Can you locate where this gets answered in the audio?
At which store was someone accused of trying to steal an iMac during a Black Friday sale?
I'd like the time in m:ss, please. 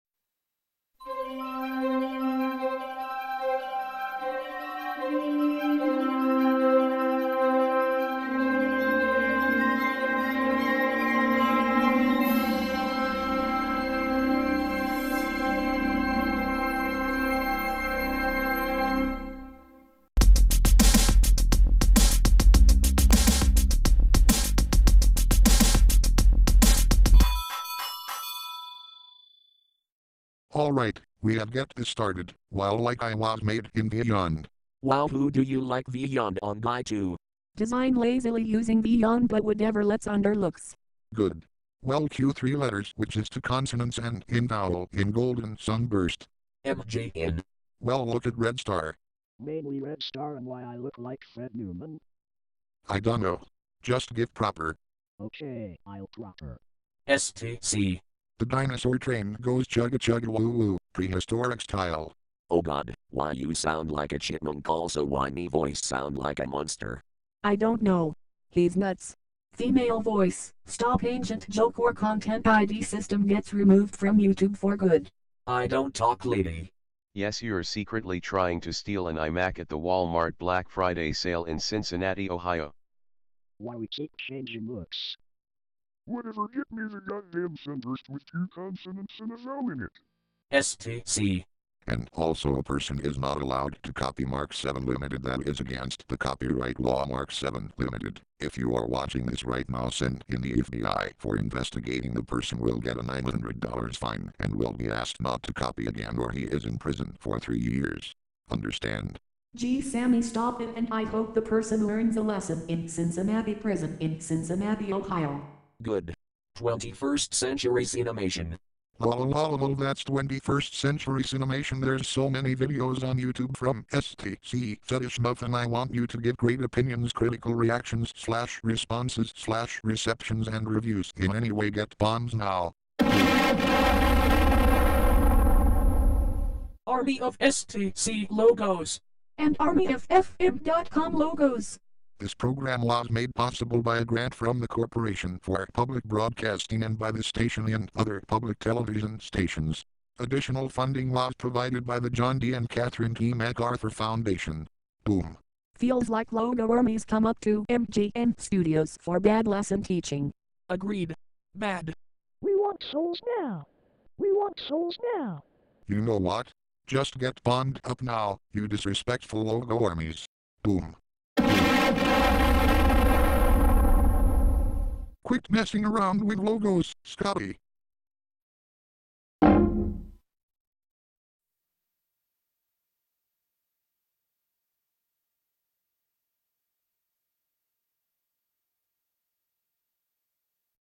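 1:19.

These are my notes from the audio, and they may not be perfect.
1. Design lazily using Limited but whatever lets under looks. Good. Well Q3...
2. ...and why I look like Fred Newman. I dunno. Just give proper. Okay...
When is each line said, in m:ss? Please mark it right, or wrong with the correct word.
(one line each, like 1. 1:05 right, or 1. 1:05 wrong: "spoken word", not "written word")
1. 0:37 wrong: "Vyond", not "Limited"
2. 0:50 right.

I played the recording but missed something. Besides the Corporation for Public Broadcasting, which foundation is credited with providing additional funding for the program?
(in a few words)
John D. and Catherine T. MacArthur Foundation.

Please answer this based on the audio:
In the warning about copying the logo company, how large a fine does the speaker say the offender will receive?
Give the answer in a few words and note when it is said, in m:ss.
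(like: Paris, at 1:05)
$900, at 1:43.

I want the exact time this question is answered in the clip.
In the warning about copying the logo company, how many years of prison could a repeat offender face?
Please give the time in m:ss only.
1:47.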